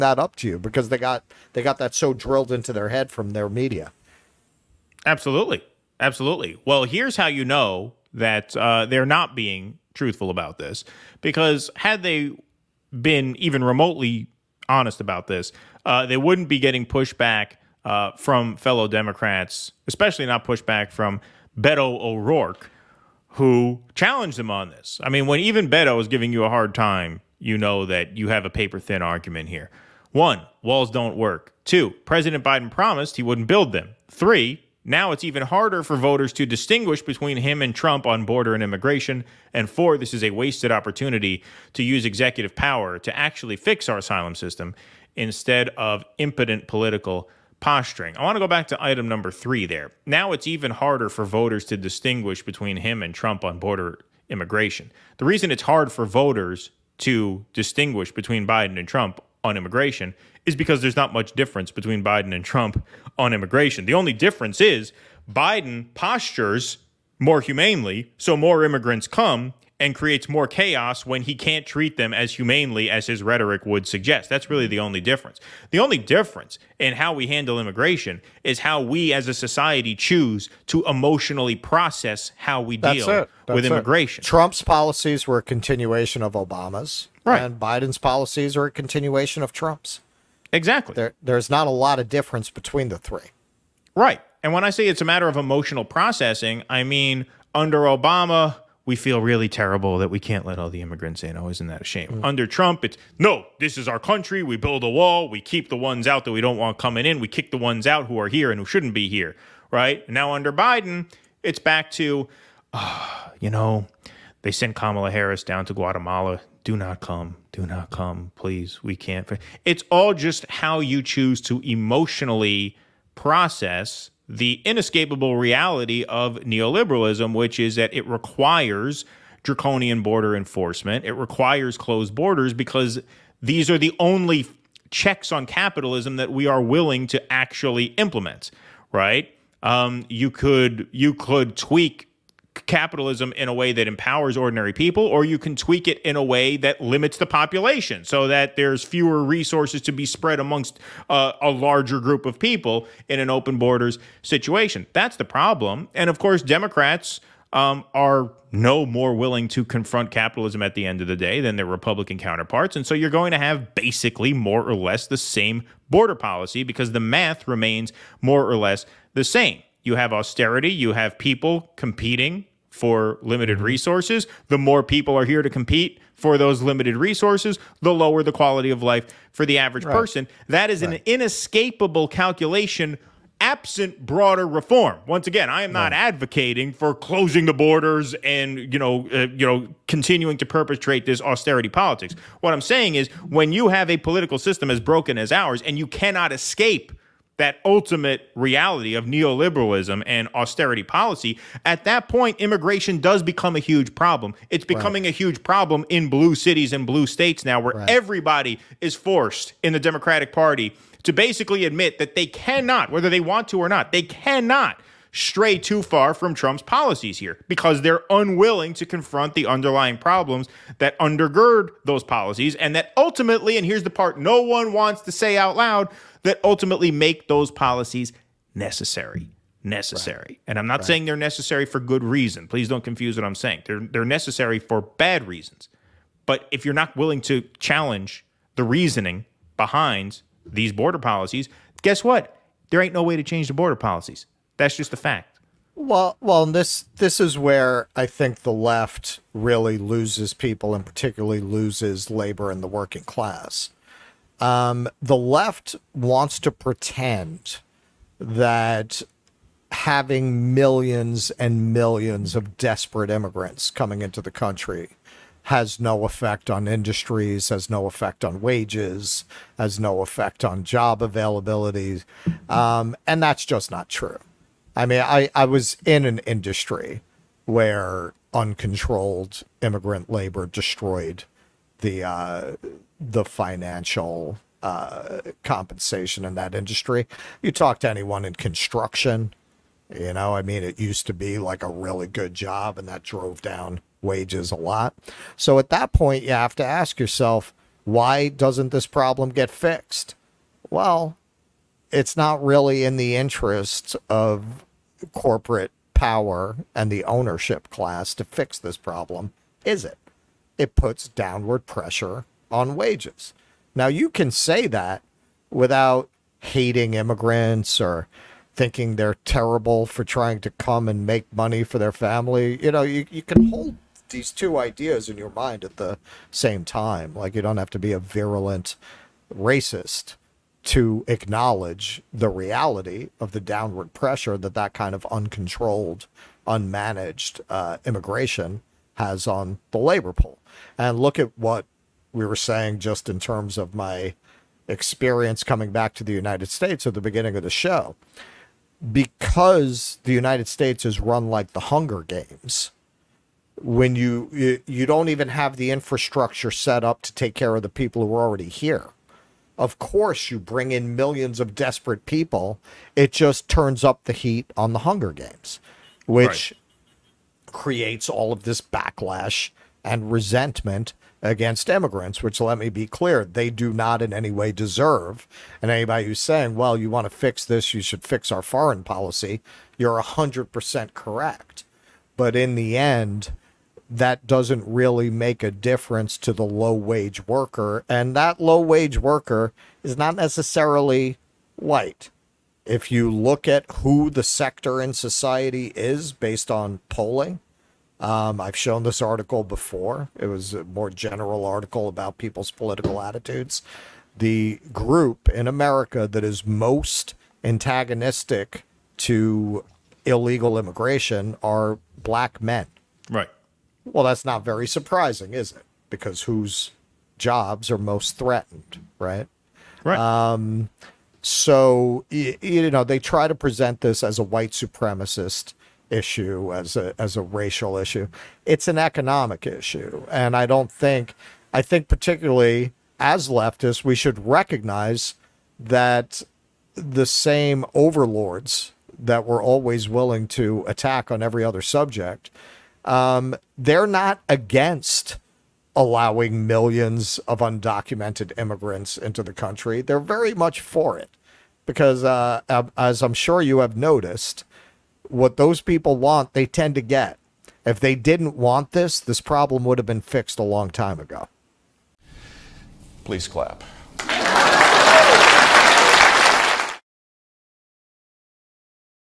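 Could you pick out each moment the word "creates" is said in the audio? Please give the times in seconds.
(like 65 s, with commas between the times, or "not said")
69 s, 367 s.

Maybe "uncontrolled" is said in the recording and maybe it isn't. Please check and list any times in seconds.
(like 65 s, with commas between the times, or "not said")
278 s, 335 s.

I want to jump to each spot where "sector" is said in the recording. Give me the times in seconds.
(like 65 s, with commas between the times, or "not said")
394 s.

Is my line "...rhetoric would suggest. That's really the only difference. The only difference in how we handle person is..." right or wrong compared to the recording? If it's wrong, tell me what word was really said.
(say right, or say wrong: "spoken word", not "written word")
wrong: "immigration", not "person".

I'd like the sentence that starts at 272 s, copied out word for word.
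Um, and that's just not true.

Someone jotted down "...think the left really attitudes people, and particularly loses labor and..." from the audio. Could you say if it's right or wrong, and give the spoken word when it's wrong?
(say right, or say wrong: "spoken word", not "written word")
wrong: "loses", not "attitudes".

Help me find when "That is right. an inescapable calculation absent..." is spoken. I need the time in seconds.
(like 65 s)
180 s.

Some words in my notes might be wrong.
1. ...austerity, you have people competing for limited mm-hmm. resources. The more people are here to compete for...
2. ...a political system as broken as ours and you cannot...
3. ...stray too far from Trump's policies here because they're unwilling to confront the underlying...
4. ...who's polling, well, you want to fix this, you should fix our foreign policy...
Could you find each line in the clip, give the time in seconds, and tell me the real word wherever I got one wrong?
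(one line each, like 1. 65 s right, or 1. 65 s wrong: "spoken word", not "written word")
1. 170 s right
2. 193 s right
3. 215 s right
4. 376 s wrong: "saying", not "polling".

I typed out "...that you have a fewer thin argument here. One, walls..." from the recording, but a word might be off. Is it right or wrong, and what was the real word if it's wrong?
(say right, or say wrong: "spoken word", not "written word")
wrong: "paper", not "fewer".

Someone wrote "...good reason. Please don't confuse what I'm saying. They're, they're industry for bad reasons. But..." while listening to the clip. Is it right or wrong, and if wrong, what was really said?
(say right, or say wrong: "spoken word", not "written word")
wrong: "necessary", not "industry".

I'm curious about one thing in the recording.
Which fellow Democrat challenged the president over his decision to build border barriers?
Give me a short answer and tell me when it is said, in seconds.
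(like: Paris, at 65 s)
Beto O'Rourke, at 21 s.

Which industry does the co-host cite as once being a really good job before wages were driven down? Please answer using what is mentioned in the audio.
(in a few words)
construction.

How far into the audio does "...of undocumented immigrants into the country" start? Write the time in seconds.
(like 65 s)
447 s.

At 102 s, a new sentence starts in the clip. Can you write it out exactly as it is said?
Under Trump, it's no, this is our country.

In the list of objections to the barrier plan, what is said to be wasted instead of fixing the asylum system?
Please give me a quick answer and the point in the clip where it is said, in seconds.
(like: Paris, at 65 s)
executive power, at 42 s.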